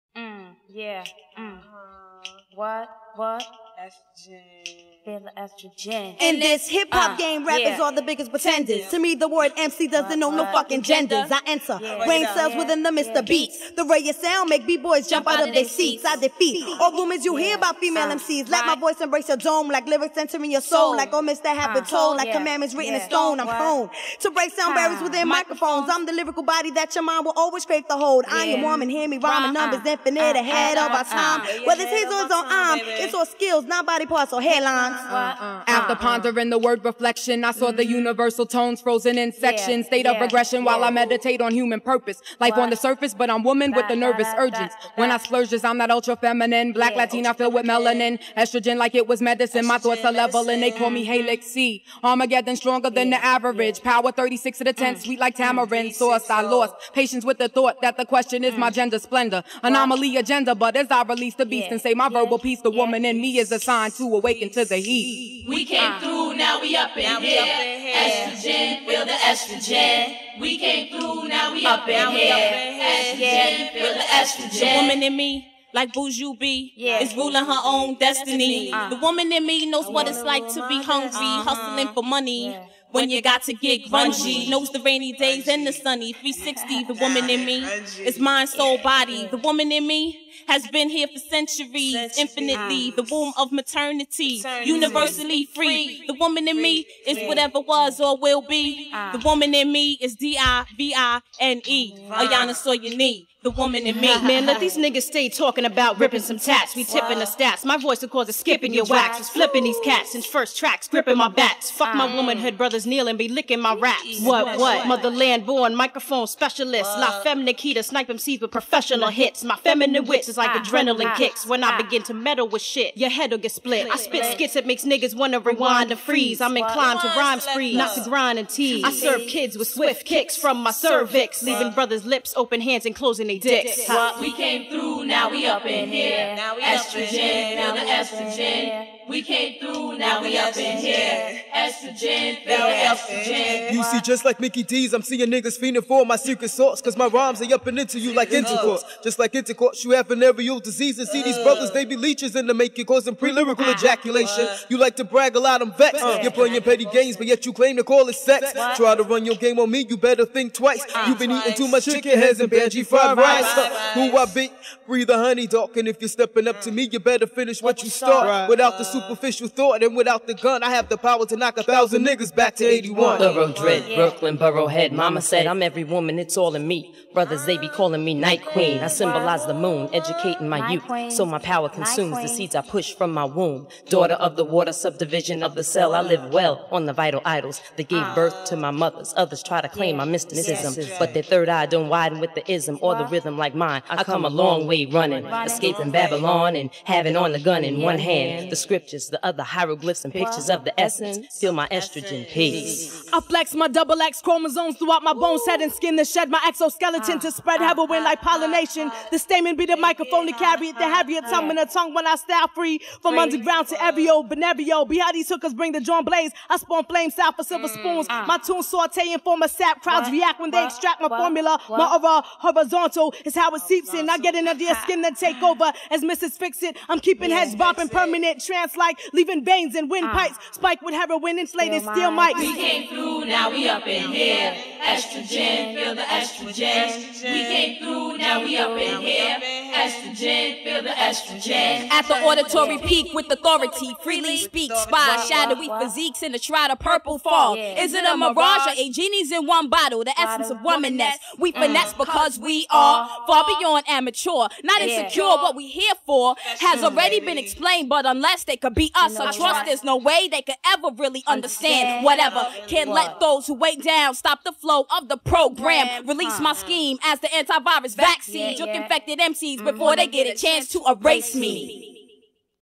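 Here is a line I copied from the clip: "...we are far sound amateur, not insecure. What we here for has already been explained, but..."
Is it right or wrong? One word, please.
wrong.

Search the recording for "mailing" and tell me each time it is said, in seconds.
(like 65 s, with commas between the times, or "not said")
not said.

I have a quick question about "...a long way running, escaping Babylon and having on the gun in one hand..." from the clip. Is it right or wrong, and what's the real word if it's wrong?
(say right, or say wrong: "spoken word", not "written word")
right.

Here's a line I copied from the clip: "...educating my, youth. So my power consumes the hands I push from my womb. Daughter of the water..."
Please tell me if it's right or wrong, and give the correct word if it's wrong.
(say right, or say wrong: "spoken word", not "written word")
wrong: "seeds", not "hands".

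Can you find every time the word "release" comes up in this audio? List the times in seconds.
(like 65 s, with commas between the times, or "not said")
61 s, 266 s.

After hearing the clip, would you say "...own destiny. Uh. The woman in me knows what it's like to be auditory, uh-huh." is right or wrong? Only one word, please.
wrong.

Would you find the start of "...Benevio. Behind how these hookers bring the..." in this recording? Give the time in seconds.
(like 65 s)
214 s.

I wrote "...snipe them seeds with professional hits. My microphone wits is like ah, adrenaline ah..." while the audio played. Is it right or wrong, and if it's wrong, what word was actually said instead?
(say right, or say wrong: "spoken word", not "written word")
wrong: "feminine", not "microphone".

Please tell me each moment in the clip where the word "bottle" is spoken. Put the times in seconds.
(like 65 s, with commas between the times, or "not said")
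249 s.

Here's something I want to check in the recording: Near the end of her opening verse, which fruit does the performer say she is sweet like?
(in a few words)
tamarind.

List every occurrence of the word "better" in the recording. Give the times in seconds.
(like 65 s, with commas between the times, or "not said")
159 s, 166 s.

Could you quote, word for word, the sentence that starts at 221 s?
My aura horizontal is how it seeps in.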